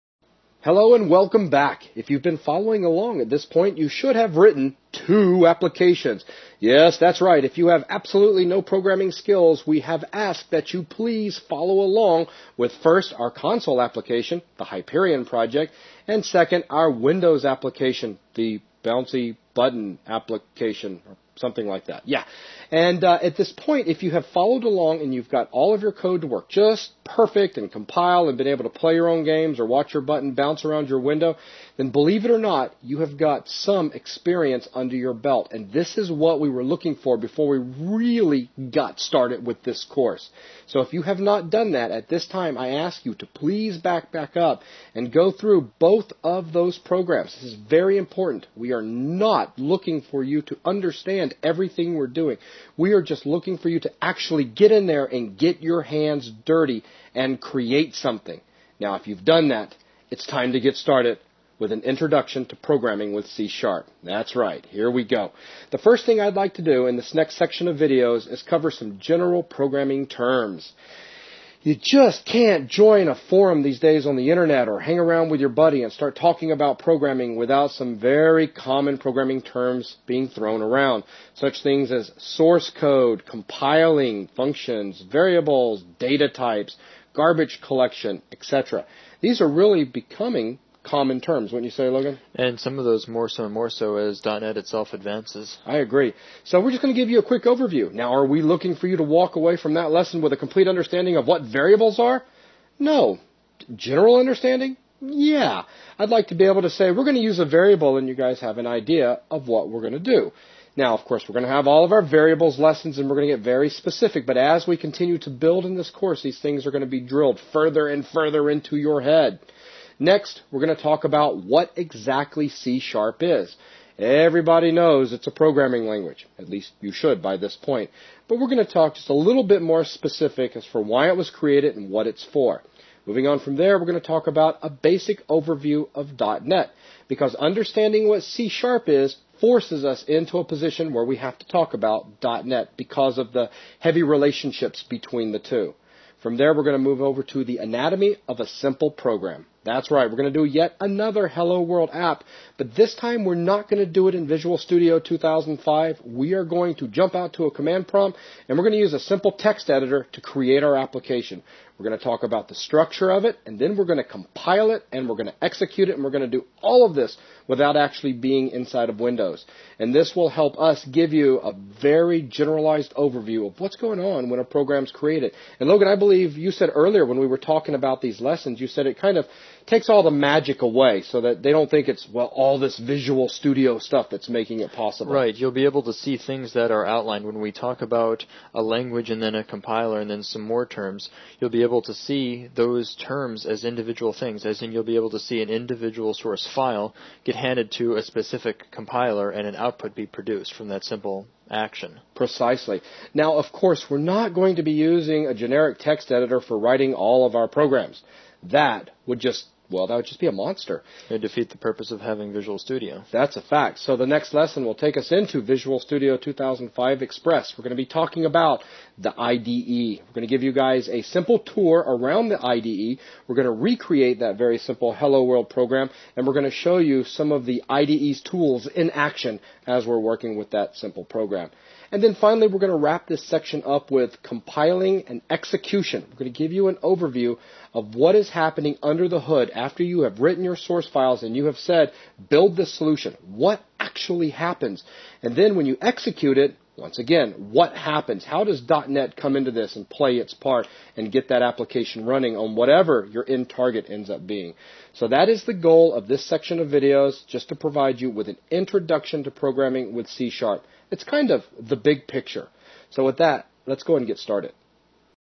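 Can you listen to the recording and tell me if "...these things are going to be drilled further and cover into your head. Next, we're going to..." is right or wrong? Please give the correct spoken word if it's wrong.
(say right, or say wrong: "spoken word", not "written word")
wrong: "further", not "cover".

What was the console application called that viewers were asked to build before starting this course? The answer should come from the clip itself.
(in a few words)
Hyperion project.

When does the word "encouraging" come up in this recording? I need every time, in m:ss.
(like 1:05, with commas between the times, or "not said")
not said.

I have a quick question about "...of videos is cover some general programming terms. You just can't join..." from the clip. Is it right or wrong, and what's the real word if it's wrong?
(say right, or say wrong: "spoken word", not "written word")
right.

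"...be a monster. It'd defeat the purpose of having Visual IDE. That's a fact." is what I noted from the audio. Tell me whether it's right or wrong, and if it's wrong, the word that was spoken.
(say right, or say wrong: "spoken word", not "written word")
wrong: "Studio", not "IDE".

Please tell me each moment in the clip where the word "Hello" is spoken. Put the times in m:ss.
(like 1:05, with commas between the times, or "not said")
0:00, 2:31, 3:44.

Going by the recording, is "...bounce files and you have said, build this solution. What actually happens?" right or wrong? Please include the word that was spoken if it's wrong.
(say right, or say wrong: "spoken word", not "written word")
wrong: "source", not "bounce".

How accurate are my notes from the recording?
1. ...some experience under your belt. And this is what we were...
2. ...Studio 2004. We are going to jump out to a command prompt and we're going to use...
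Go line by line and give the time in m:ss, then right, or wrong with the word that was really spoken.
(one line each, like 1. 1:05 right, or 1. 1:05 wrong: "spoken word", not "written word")
1. 0:33 right
2. 2:34 wrong: "2005", not "2004".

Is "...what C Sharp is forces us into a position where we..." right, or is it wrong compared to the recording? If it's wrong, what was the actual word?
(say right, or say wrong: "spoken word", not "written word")
right.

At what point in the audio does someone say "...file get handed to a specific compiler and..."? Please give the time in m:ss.
3:16.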